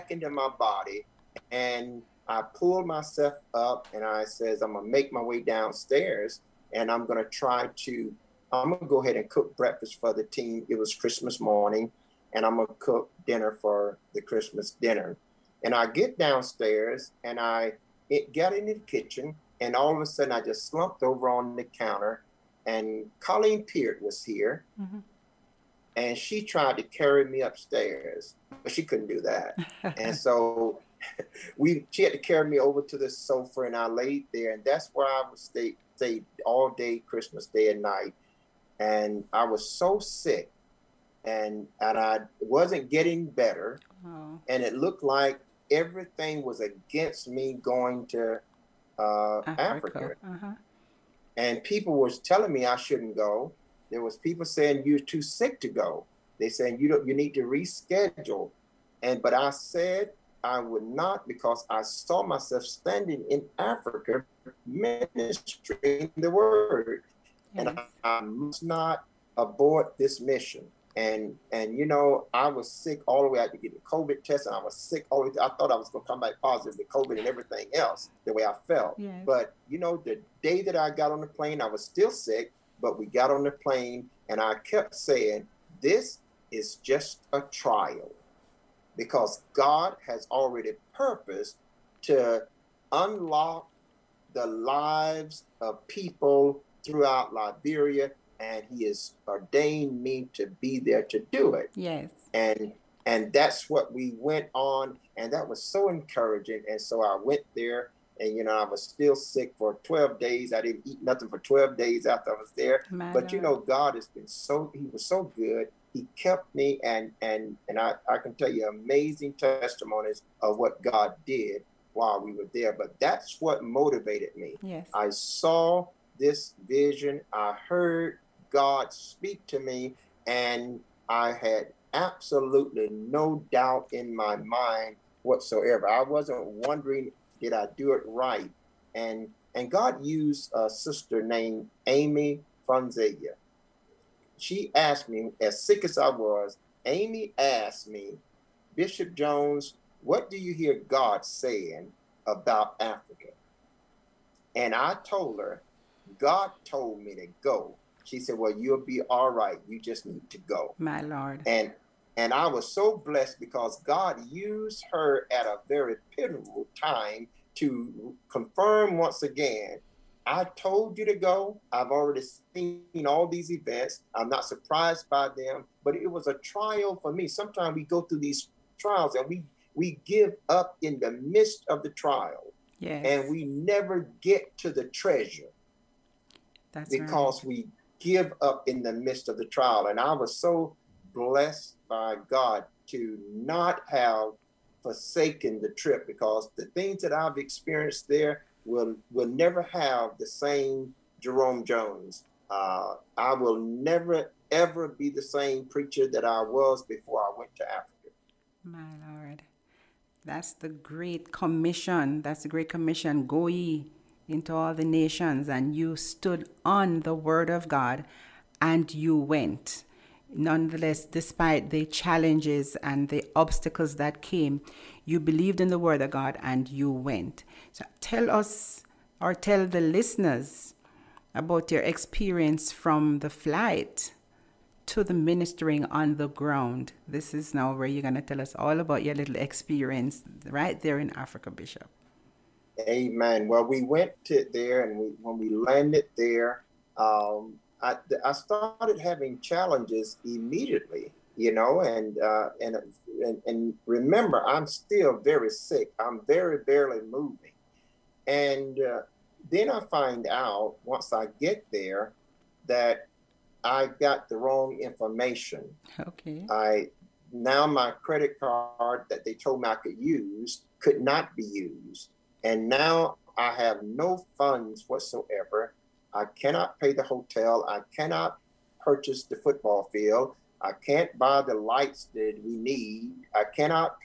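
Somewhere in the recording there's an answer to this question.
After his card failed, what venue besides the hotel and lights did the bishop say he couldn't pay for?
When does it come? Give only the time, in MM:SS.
04:39.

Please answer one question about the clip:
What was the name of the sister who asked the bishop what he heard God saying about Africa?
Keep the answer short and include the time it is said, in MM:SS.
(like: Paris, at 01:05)
Amy Franzia, at 02:21.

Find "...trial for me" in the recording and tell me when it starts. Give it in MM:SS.
02:56.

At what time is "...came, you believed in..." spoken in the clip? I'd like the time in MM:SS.
03:44.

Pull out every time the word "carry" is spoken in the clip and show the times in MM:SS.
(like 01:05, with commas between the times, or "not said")
00:26, 00:32.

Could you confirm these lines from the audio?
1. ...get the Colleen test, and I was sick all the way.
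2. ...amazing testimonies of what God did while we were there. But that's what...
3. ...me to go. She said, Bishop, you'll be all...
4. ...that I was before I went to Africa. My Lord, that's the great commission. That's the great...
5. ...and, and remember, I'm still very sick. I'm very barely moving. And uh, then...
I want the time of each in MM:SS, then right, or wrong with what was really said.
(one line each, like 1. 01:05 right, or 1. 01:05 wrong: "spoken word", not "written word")
1. 01:13 wrong: "COVID", not "Colleen"
2. 01:58 right
3. 02:37 wrong: "Well", not "Bishop"
4. 03:26 right
5. 04:13 right.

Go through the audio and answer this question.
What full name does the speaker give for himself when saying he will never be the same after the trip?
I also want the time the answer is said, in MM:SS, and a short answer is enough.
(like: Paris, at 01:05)
Jerome Jones, at 03:21.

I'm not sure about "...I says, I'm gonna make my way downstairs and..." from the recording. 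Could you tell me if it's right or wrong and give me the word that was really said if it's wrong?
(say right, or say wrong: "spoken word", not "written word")
right.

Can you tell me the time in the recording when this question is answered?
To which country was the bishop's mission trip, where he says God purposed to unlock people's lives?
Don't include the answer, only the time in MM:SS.
01:37.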